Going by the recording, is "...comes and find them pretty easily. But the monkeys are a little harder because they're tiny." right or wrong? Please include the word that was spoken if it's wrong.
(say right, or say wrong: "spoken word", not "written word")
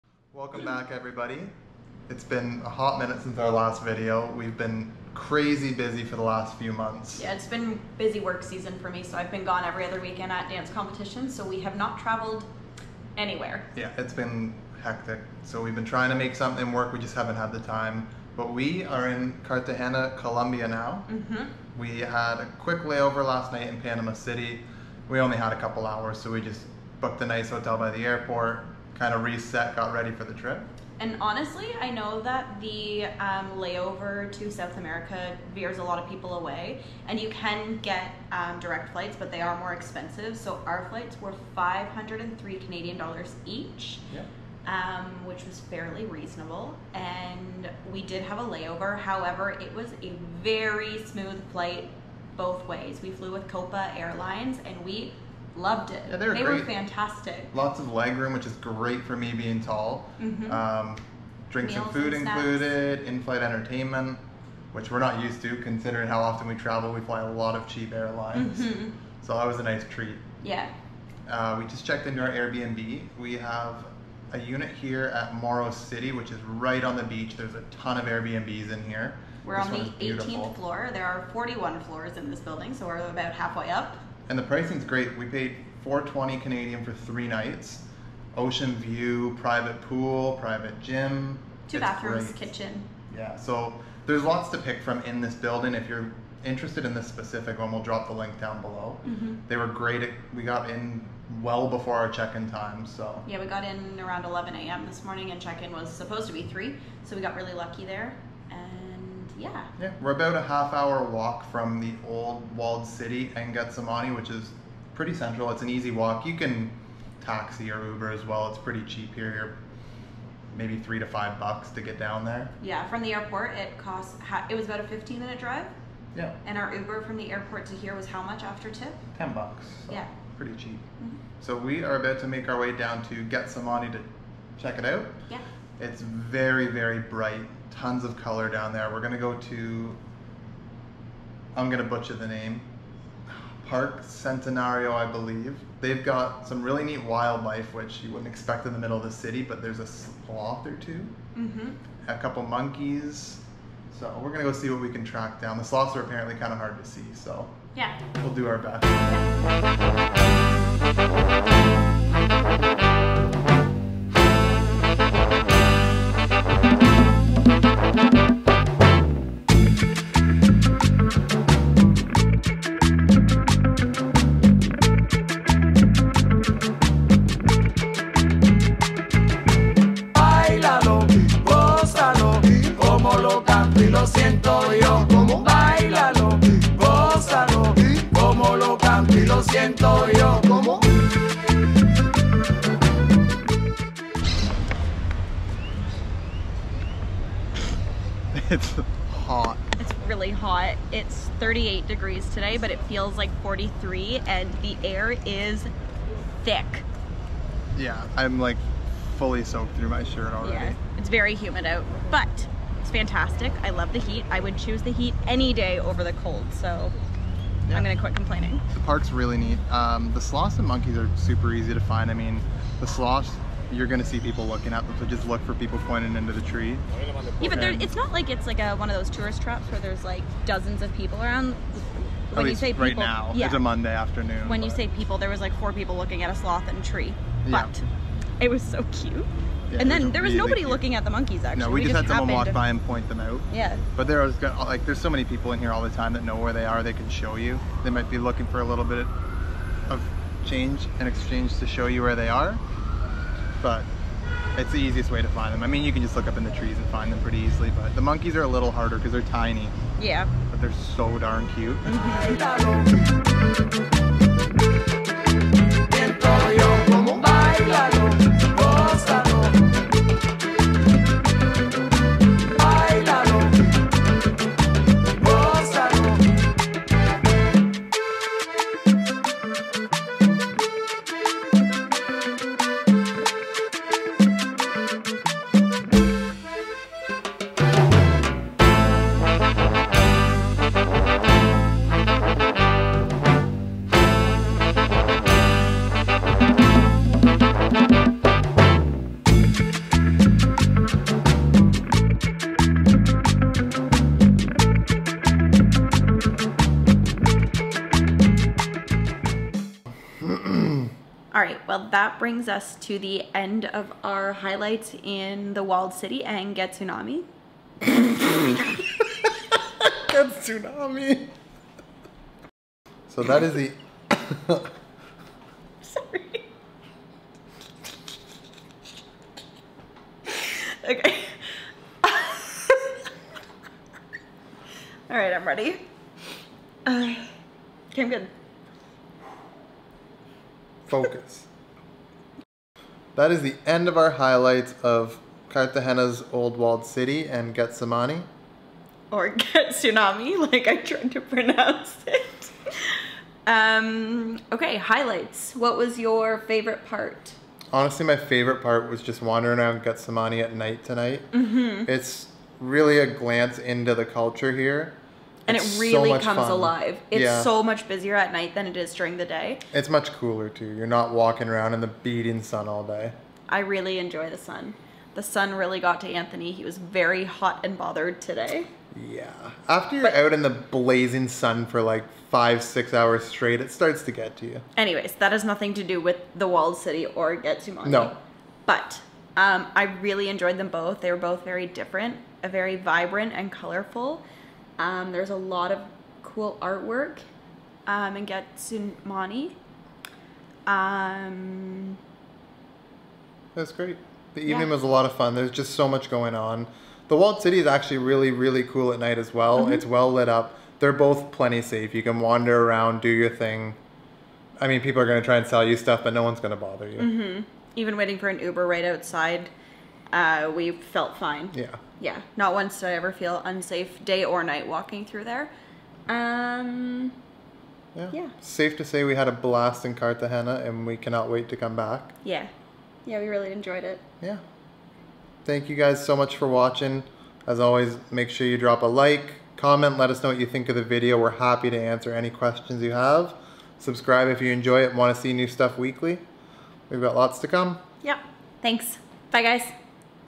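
wrong: "trees", not "comes".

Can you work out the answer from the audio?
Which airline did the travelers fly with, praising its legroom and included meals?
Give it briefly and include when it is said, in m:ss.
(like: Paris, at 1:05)
Copa Airlines, at 0:53.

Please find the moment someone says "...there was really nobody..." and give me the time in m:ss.
4:00.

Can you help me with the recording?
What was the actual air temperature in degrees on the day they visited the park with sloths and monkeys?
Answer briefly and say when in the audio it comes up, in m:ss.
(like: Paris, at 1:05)
38, at 3:21.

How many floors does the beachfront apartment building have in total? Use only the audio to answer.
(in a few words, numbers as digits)
41.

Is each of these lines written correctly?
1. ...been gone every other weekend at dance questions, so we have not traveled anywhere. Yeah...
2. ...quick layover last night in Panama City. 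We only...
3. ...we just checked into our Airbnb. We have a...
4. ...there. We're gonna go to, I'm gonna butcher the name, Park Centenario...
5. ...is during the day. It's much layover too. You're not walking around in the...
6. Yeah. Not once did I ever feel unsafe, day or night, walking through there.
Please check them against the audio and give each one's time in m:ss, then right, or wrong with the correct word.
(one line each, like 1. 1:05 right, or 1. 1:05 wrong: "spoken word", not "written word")
1. 0:09 wrong: "competitions", not "questions"
2. 0:22 right
3. 1:11 right
4. 2:18 right
5. 6:08 wrong: "cooler", not "layover"
6. 7:01 right.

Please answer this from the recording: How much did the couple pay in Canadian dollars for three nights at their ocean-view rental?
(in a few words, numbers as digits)
420.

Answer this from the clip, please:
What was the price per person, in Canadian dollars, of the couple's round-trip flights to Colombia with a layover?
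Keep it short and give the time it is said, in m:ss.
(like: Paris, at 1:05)
503, at 0:41.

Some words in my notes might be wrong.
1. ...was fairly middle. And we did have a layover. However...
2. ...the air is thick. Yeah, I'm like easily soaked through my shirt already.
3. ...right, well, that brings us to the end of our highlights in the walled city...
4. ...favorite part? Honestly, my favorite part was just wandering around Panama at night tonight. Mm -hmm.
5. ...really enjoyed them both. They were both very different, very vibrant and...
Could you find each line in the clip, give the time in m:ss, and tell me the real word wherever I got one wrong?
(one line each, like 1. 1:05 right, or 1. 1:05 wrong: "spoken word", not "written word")
1. 0:45 wrong: "reasonable", not "middle"
2. 3:24 wrong: "fully", not "easily"
3. 5:11 right
4. 5:56 wrong: "Getsemani", not "Panama"
5. 6:30 right.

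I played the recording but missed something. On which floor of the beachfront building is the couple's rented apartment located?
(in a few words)
18th floor.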